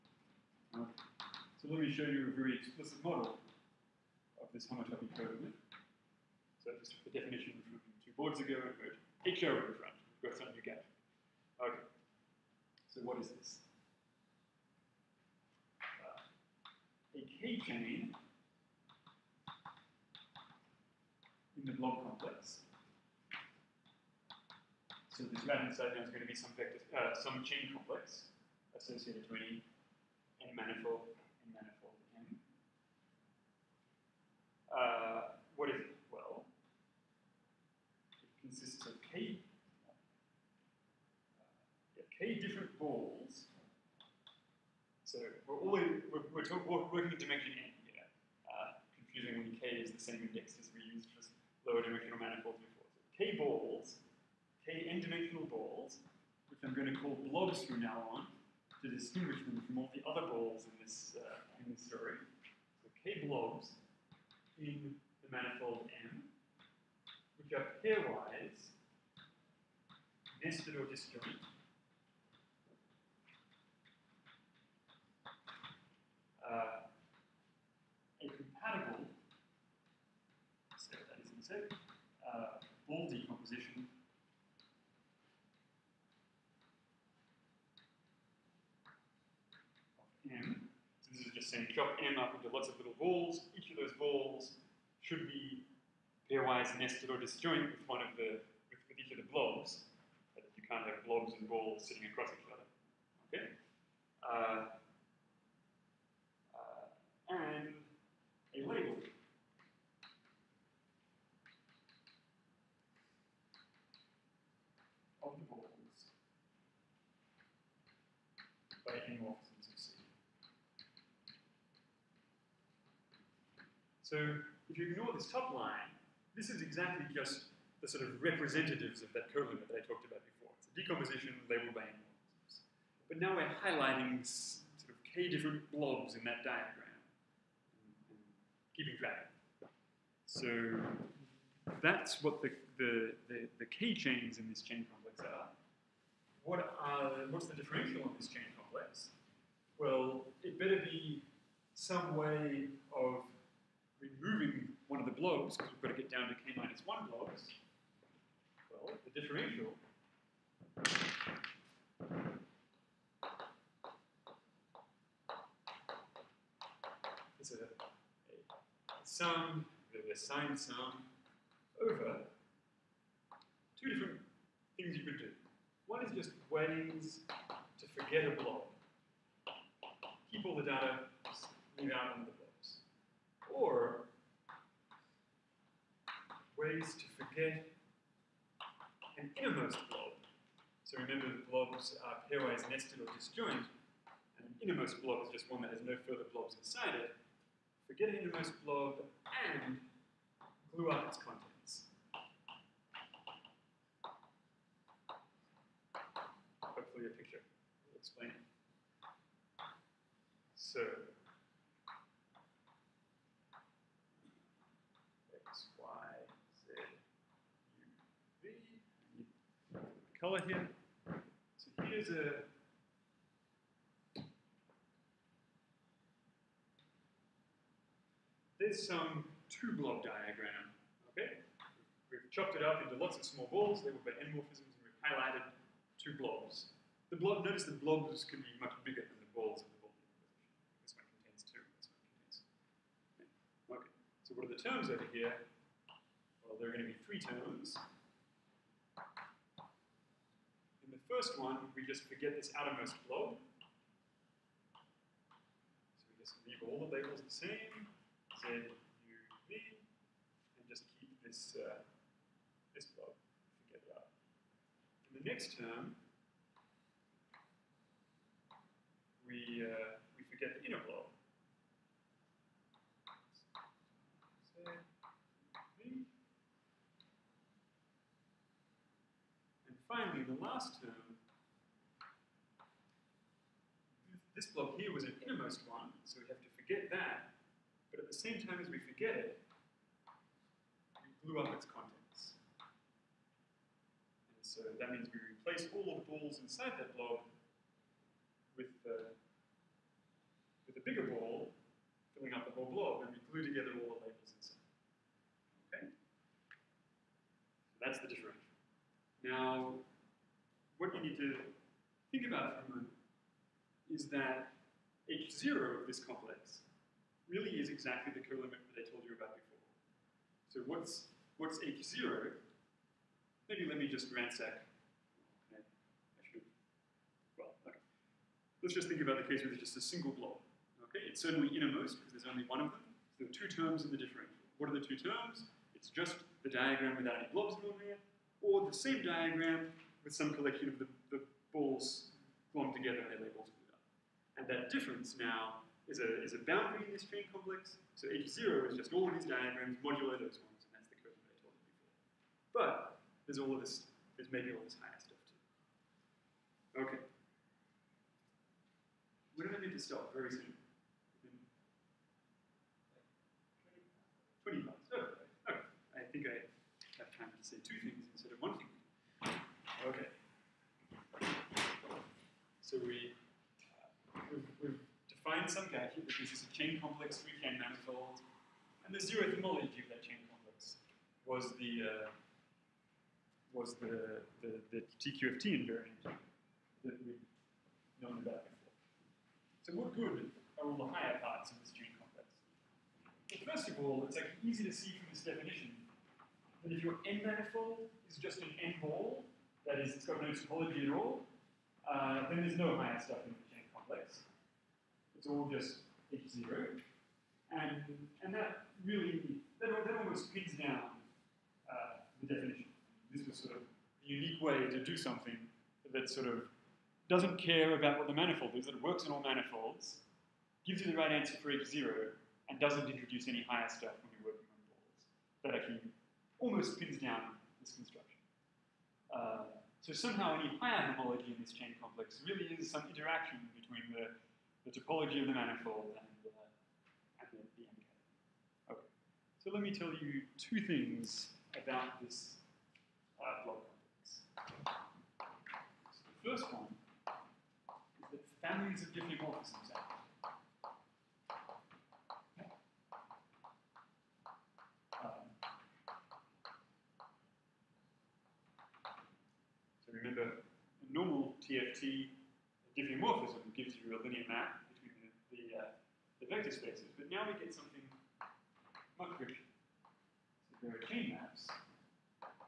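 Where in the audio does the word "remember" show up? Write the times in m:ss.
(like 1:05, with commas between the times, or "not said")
3:11, 7:39.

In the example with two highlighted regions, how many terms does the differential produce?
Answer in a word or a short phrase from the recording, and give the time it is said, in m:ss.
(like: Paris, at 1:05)
3, at 4:07.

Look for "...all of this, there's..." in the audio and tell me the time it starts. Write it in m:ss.
5:53.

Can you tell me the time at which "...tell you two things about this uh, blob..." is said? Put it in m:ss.
7:19.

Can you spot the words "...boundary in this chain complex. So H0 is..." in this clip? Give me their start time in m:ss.
5:46.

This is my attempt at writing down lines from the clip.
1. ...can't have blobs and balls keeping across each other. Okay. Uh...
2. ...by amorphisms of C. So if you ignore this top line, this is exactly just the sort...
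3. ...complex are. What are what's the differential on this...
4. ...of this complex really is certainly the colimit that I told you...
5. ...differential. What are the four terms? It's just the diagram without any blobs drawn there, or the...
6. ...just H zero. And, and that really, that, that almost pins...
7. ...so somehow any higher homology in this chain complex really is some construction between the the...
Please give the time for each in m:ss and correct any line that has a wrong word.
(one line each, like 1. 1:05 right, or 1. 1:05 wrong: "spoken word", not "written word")
1. 1:40 wrong: "sitting", not "keeping"
2. 1:58 right
3. 2:24 right
4. 5:15 wrong: "exactly", not "certainly"
5. 5:33 wrong: "two", not "four"
6. 6:45 right
7. 7:09 wrong: "interaction", not "construction".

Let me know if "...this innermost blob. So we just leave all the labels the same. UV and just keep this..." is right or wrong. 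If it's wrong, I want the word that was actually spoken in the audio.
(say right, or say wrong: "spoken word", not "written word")
wrong: "outermost", not "innermost".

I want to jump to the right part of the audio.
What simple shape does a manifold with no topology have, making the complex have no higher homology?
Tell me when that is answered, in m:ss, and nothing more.
6:38.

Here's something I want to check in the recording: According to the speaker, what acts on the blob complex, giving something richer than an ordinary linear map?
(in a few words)
families of diffeomorphisms.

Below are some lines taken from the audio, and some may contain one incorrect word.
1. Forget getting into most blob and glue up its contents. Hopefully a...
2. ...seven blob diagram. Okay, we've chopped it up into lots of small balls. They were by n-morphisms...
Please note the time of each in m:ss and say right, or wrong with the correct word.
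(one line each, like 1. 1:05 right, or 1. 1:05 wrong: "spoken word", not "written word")
1. 3:17 right
2. 3:49 wrong: "two", not "seven".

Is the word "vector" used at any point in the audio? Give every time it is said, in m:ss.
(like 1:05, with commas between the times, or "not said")
0:26, 7:46.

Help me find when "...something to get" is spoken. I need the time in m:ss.
0:10.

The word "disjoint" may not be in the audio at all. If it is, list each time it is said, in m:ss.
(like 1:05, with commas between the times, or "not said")
1:10, 1:37, 3:13.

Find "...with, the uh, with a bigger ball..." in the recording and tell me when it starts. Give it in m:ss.
4:58.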